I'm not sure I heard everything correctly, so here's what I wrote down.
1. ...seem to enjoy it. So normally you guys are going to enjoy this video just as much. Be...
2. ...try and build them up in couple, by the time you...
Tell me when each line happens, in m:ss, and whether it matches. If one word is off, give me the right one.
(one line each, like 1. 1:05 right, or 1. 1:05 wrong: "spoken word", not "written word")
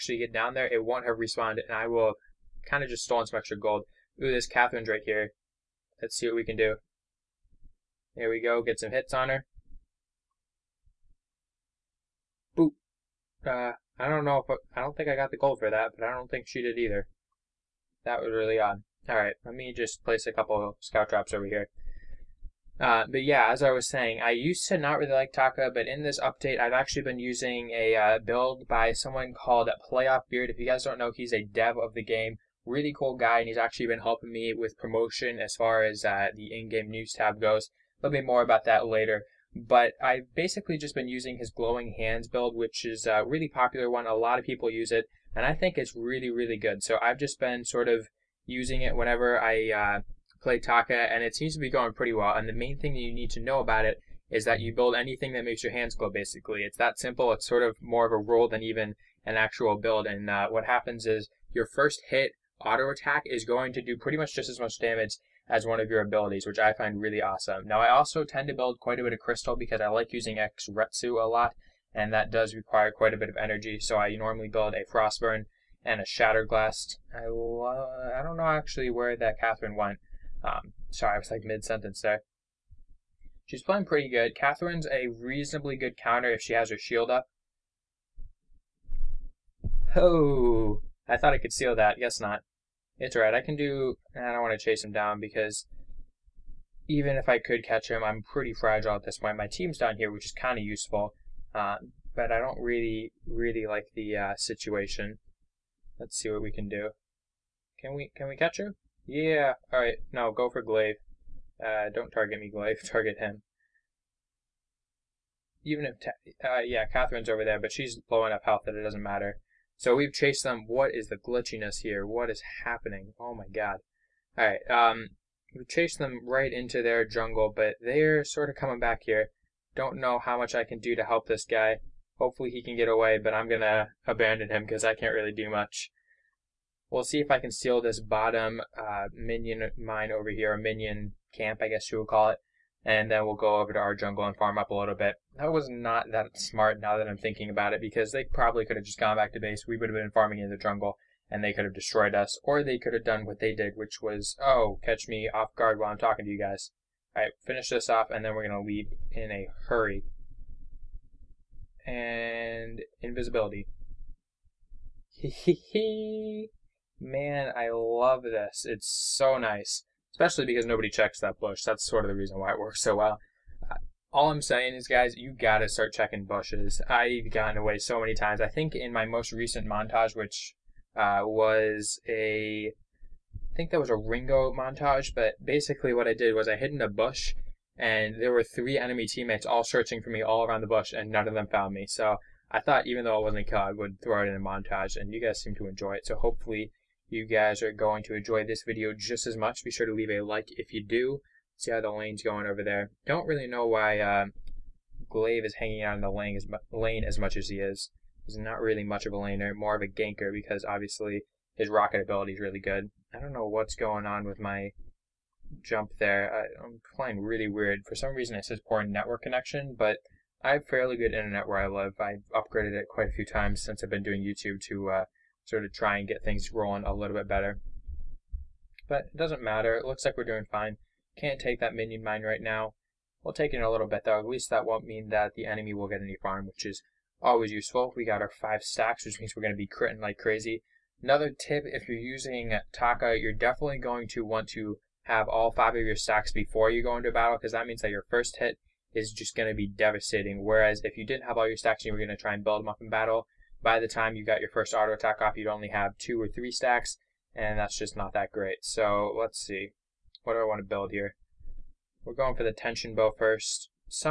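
1. 3:15 wrong: "hopefully", not "normally"
2. 4:12 wrong: "battle", not "couple".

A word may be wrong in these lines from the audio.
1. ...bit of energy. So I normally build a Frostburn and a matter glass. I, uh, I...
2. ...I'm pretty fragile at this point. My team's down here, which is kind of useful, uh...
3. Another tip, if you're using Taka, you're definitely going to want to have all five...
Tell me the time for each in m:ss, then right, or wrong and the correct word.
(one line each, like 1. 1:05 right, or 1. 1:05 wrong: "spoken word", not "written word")
1. 1:13 wrong: "shatter", not "matter"
2. 1:38 right
3. 4:01 right.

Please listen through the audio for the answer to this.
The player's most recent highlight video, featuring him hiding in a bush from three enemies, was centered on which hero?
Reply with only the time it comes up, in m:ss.
3:03.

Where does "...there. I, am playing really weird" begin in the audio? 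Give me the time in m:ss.
3:35.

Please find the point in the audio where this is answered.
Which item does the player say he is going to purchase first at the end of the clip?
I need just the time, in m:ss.
4:22.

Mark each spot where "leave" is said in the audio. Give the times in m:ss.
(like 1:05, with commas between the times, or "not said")
2:38, 3:19.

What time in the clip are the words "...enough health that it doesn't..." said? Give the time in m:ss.
1:58.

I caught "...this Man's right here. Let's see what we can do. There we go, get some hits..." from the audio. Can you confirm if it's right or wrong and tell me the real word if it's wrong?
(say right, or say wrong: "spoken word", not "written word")
wrong: "Catherine", not "Man".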